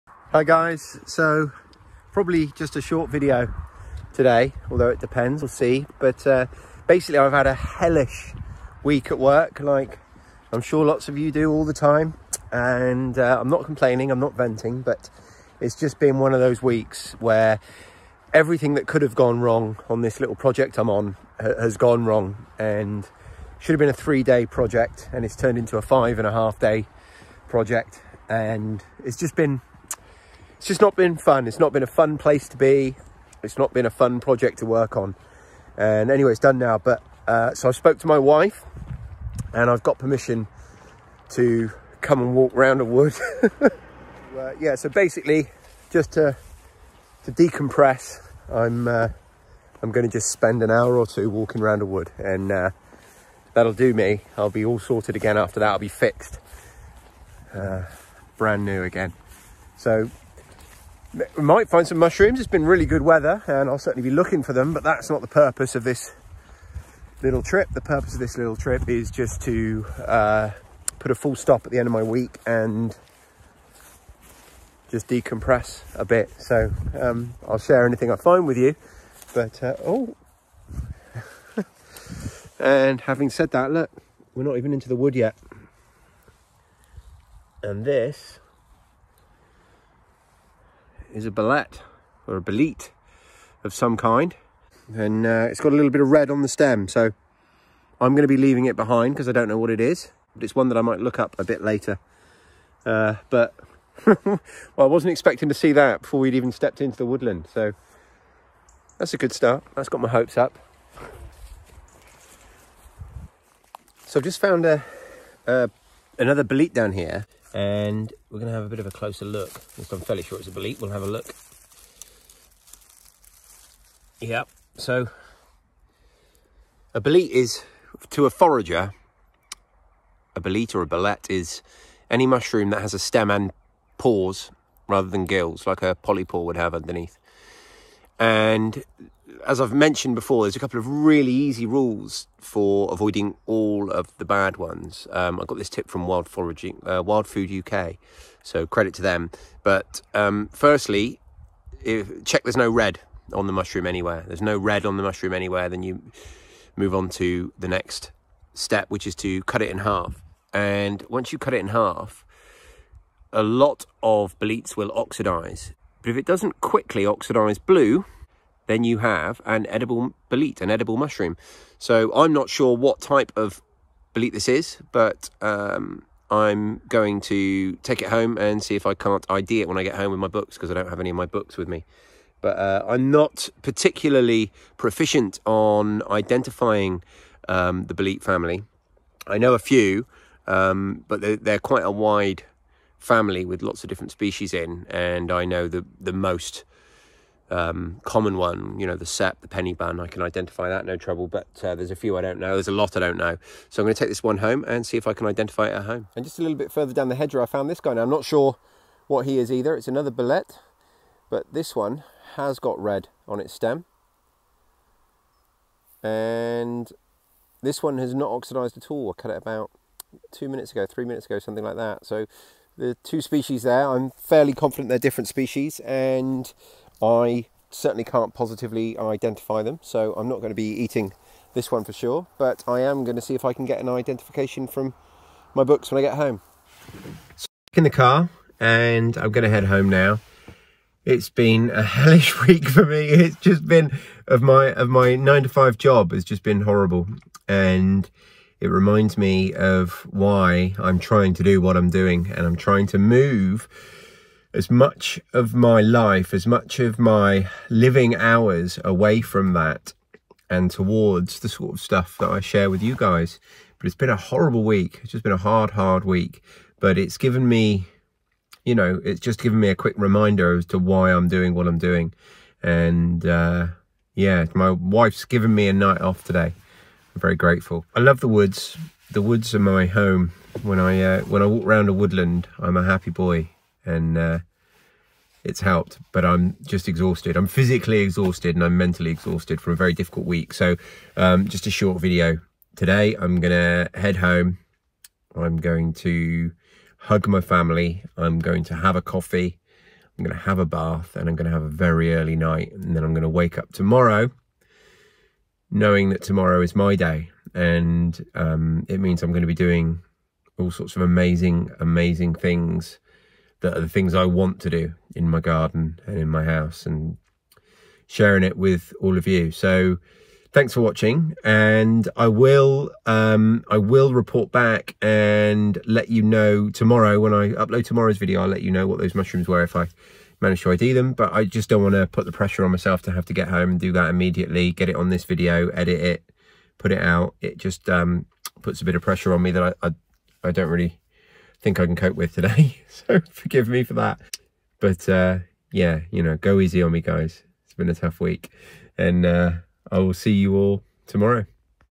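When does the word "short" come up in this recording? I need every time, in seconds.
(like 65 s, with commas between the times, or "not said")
2 s, 291 s.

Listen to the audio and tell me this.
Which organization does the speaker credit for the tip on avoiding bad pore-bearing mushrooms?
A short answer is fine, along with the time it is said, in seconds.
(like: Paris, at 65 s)
Wild Food UK, at 147 s.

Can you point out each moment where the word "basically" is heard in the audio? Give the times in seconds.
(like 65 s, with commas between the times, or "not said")
6 s, 44 s.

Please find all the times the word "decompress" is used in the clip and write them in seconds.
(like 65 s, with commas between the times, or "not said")
47 s, 75 s.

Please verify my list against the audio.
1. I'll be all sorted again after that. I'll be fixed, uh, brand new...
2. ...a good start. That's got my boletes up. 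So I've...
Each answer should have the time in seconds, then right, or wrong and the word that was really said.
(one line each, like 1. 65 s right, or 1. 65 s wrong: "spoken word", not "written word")
1. 54 s right
2. 109 s wrong: "hopes", not "boletes".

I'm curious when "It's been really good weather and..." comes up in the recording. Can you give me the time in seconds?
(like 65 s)
62 s.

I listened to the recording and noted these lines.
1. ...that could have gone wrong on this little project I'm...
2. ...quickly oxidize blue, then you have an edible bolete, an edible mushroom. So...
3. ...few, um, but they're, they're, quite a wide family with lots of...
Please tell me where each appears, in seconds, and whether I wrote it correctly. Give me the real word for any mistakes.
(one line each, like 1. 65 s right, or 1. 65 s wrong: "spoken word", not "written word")
1. 18 s right
2. 166 s right
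3. 189 s right.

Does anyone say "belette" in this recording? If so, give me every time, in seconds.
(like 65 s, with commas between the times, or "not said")
91 s, 130 s.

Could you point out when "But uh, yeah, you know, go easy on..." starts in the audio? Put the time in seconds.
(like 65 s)
344 s.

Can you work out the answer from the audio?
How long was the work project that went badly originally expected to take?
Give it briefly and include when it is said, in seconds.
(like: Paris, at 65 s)
3 days, at 24 s.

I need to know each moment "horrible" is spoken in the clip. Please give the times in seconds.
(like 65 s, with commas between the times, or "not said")
246 s, 264 s.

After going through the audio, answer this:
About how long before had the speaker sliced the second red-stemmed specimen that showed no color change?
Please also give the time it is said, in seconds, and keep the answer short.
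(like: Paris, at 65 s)
2 minutes, at 220 s.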